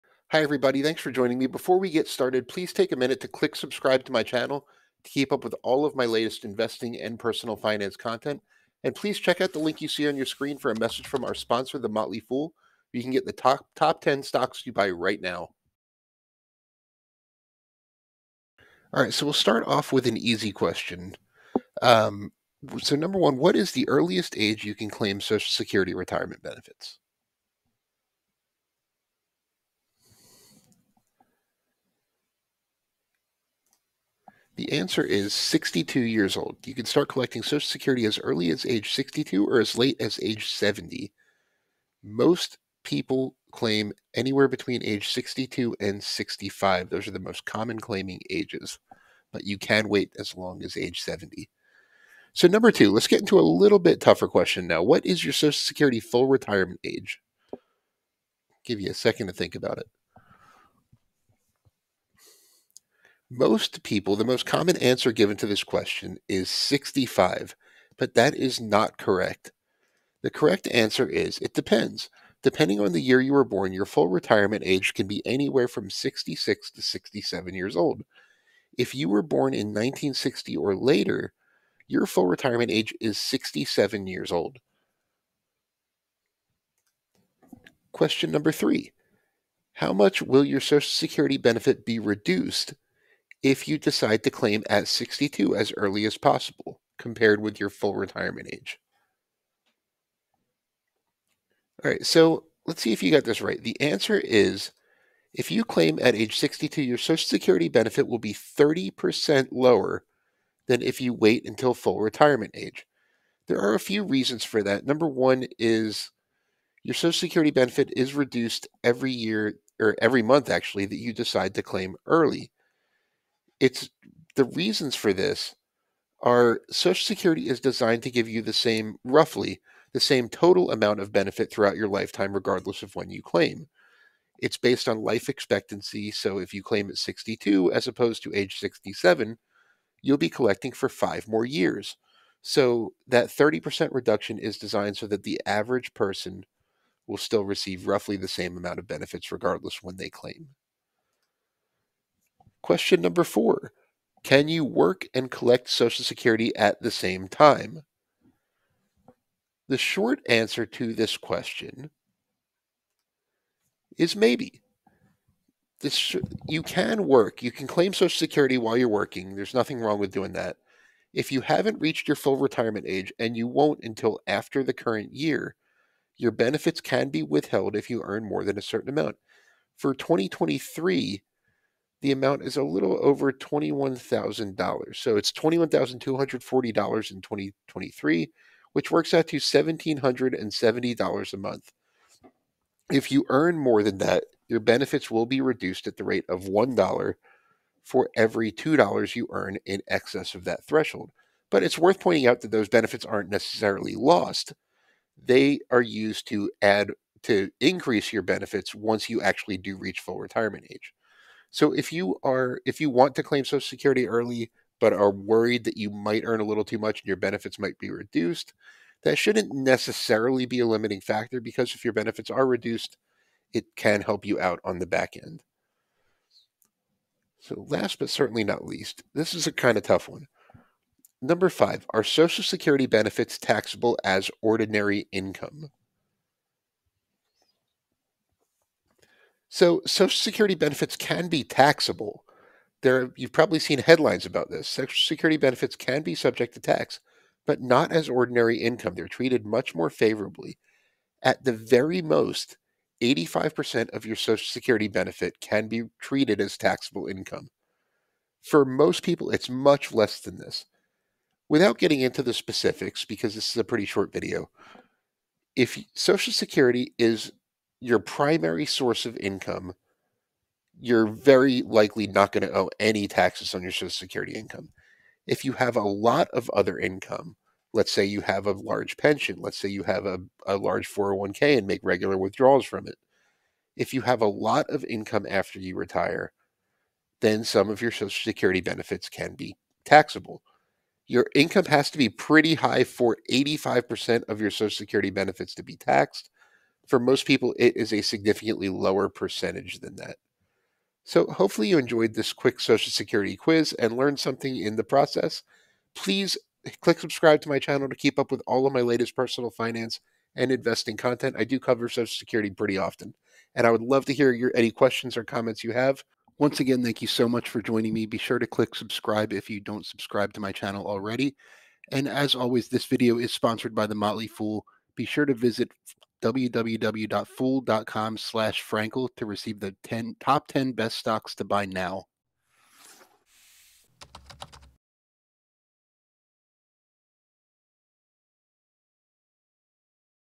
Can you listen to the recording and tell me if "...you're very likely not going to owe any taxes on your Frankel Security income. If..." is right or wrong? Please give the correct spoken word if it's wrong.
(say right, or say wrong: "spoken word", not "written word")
wrong: "Social", not "Frankel".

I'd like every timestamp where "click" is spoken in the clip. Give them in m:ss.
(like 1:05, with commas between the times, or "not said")
0:03, 5:06, 5:18.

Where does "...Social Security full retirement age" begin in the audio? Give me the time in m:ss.
0:55.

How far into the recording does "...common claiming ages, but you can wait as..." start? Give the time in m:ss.
0:47.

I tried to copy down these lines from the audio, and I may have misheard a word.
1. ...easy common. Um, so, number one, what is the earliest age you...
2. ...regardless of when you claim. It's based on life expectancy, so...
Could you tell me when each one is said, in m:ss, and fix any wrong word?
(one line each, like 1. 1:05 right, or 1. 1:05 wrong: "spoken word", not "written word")
1. 0:20 wrong: "question", not "common"
2. 2:12 right.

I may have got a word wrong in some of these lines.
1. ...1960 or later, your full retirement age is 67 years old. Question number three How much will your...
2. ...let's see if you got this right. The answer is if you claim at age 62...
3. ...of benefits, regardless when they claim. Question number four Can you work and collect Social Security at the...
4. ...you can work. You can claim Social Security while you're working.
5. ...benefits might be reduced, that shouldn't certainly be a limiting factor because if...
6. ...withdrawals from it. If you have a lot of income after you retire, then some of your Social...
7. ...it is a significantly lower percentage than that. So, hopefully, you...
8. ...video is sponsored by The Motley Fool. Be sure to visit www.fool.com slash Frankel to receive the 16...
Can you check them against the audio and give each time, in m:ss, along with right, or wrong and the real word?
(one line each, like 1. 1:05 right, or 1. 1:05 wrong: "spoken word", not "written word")
1. 1:19 right
2. 1:42 right
3. 2:28 right
4. 2:46 right
5. 3:37 wrong: "necessarily", not "certainly"
6. 4:42 right
7. 4:57 right
8. 5:22 wrong: "10", not "16".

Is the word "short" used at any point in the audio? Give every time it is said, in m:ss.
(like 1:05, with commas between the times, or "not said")
2:39, 4:23.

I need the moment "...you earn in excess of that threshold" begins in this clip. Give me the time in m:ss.
3:19.